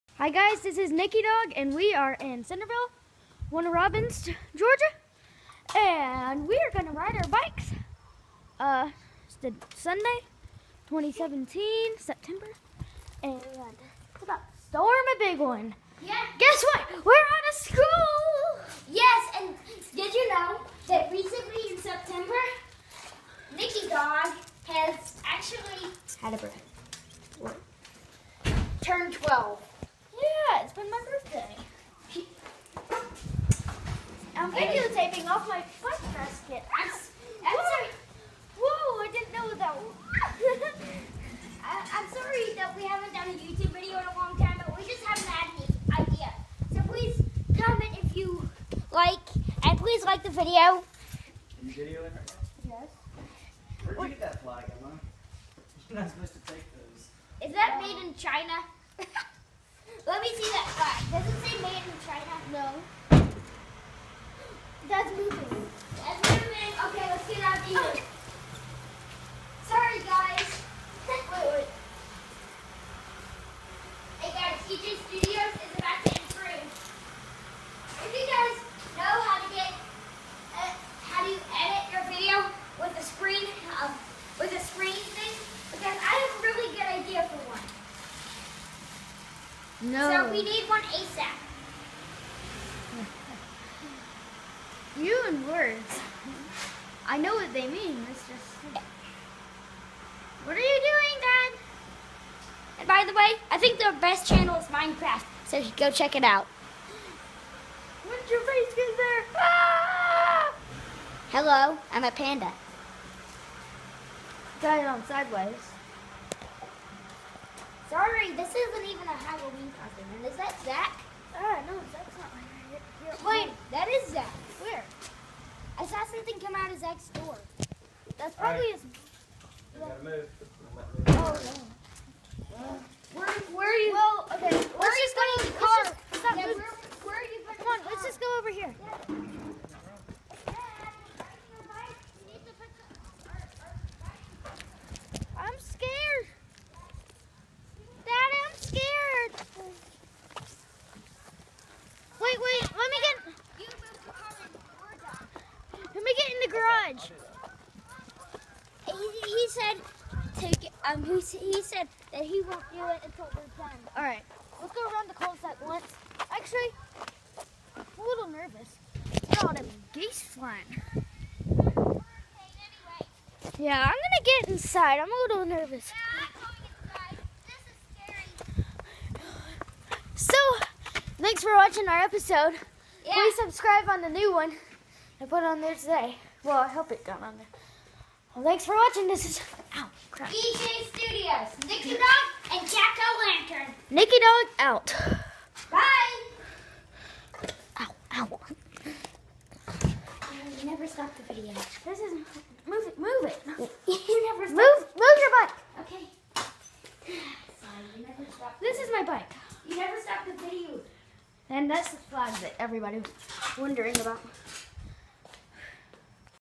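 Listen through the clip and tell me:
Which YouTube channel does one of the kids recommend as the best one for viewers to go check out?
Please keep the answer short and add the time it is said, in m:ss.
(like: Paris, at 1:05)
Minecraft, at 1:44.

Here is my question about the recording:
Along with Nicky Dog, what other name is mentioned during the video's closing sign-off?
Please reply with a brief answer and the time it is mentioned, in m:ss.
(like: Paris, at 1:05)
Jack O' Lantern, at 3:12.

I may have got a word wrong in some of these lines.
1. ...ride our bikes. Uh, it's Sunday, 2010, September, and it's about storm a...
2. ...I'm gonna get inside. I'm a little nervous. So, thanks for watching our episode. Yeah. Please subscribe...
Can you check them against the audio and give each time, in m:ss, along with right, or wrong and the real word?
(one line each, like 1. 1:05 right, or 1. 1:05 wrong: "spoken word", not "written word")
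1. 0:06 wrong: "2017", not "2010"
2. 2:53 right.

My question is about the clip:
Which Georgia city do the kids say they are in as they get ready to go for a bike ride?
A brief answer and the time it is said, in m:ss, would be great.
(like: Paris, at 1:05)
Warner Robins, at 0:03.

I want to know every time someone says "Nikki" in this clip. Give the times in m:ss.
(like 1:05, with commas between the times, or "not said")
0:00, 0:23.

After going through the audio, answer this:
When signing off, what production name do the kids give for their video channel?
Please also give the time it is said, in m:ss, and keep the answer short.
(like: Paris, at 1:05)
EJ Studios, at 3:10.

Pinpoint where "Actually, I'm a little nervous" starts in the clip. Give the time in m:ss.
2:46.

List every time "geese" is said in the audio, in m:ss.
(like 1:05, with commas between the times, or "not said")
2:49.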